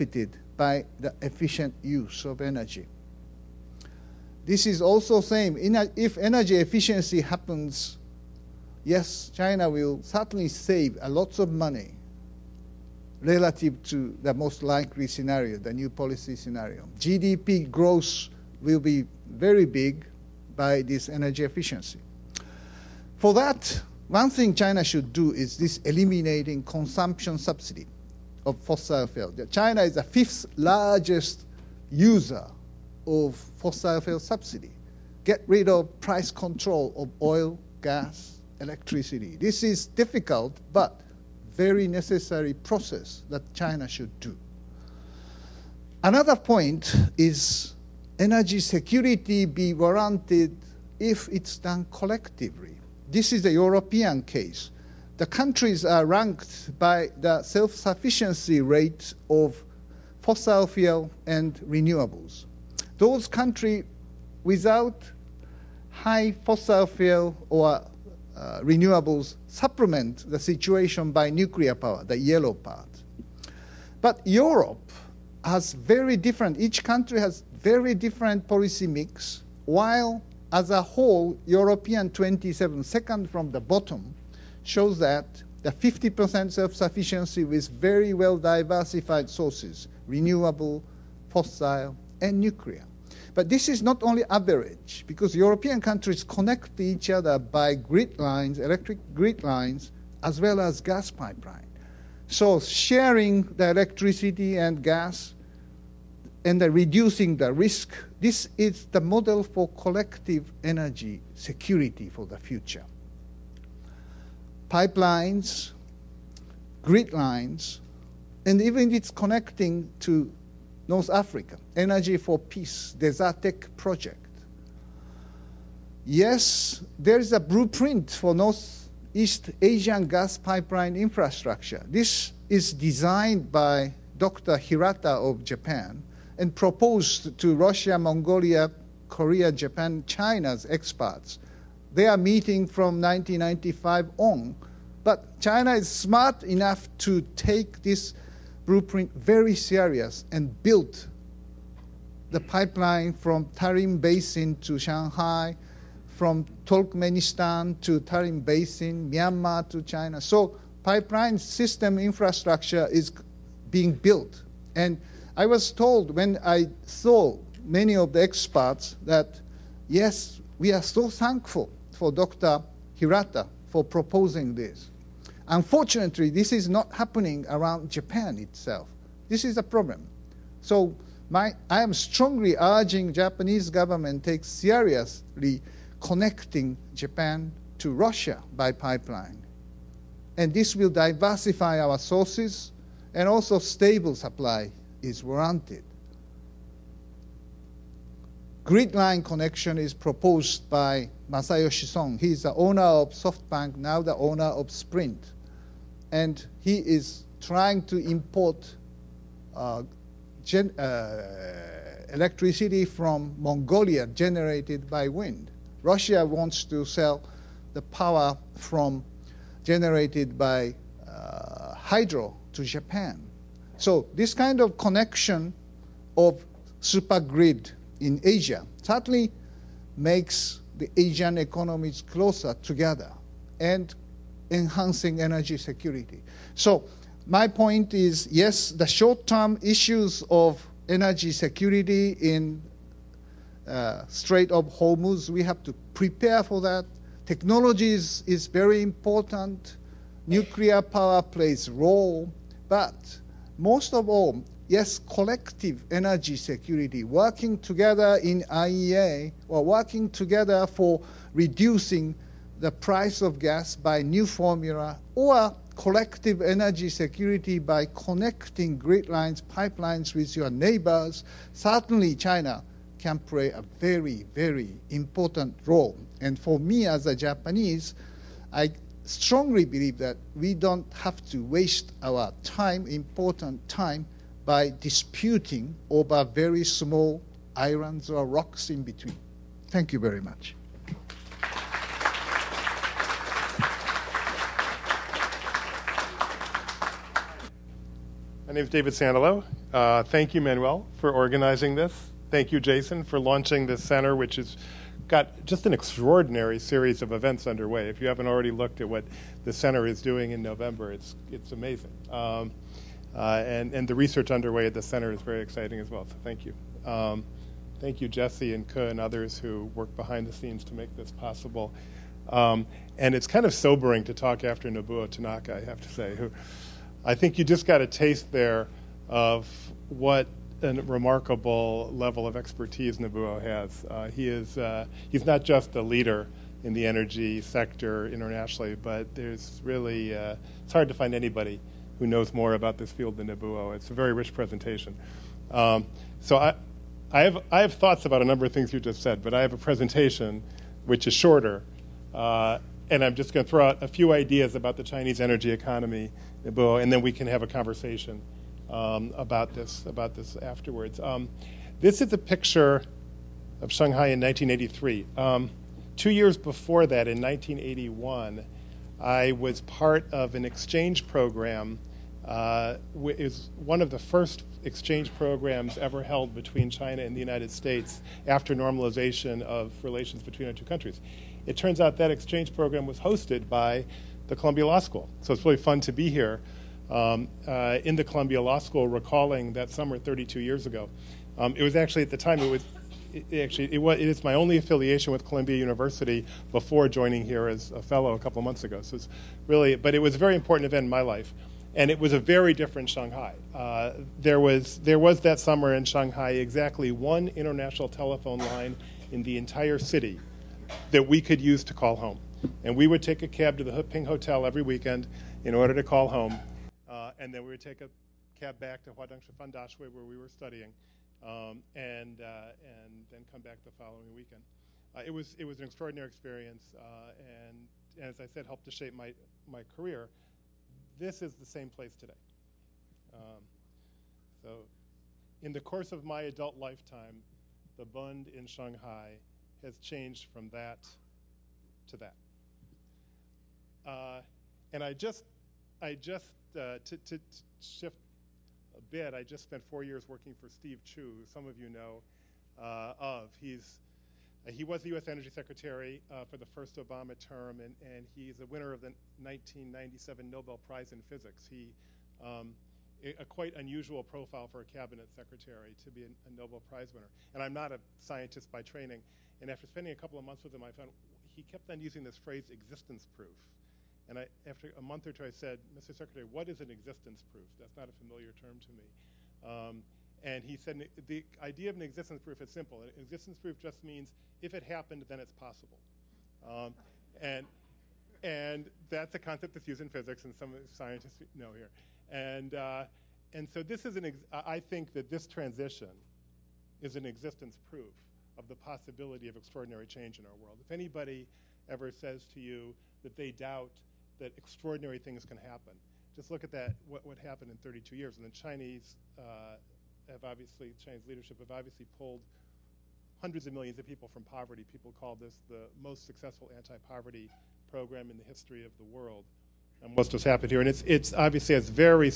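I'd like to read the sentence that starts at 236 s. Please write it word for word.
So my point is, yes, the short-term issues of energy security in uh, Strait of Hormuz, we have to prepare for that.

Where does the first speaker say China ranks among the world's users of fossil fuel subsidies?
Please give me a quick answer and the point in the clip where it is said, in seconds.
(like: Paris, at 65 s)
fifth, at 30 s.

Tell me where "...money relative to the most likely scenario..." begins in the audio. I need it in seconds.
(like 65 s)
11 s.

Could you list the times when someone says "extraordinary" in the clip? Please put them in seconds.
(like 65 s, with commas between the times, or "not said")
305 s, 425 s, 499 s, 504 s.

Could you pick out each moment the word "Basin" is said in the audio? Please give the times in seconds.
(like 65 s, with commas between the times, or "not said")
153 s, 158 s.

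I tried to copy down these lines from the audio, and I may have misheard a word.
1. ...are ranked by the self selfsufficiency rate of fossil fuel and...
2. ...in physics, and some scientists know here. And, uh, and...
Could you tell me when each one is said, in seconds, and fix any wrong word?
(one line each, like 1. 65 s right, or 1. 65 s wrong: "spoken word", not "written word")
1. 55 s wrong: "sufficiency", not "selfsufficiency"
2. 489 s right.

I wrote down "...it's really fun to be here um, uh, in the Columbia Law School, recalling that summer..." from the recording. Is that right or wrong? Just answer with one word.
right.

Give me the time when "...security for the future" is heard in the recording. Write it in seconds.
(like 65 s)
111 s.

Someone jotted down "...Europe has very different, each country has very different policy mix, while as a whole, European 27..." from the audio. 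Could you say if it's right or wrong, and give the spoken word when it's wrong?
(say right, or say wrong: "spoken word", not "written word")
right.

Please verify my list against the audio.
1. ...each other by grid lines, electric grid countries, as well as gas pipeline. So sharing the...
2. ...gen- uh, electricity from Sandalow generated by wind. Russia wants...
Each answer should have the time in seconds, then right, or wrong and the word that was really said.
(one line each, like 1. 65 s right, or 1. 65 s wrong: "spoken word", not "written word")
1. 96 s wrong: "lines", not "countries"
2. 210 s wrong: "Mongolia", not "Sandalow".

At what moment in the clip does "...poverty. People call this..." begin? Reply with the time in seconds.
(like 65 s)
514 s.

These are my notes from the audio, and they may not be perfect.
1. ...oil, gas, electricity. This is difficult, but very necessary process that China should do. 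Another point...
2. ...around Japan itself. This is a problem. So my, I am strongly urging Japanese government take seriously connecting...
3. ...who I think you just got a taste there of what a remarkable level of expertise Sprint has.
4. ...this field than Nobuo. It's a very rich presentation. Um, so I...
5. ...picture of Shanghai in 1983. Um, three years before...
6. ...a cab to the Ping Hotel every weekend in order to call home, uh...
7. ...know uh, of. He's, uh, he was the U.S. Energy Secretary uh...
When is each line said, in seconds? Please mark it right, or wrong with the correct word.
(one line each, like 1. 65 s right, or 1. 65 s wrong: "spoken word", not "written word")
1. 37 s right
2. 177 s right
3. 326 s wrong: "Nobuo", not "Sprint"
4. 342 s right
5. 362 s wrong: "two", not "three"
6. 413 s right
7. 451 s right.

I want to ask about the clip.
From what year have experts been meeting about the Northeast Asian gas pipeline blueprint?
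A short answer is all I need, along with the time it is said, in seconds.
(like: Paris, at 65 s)
1995, at 143 s.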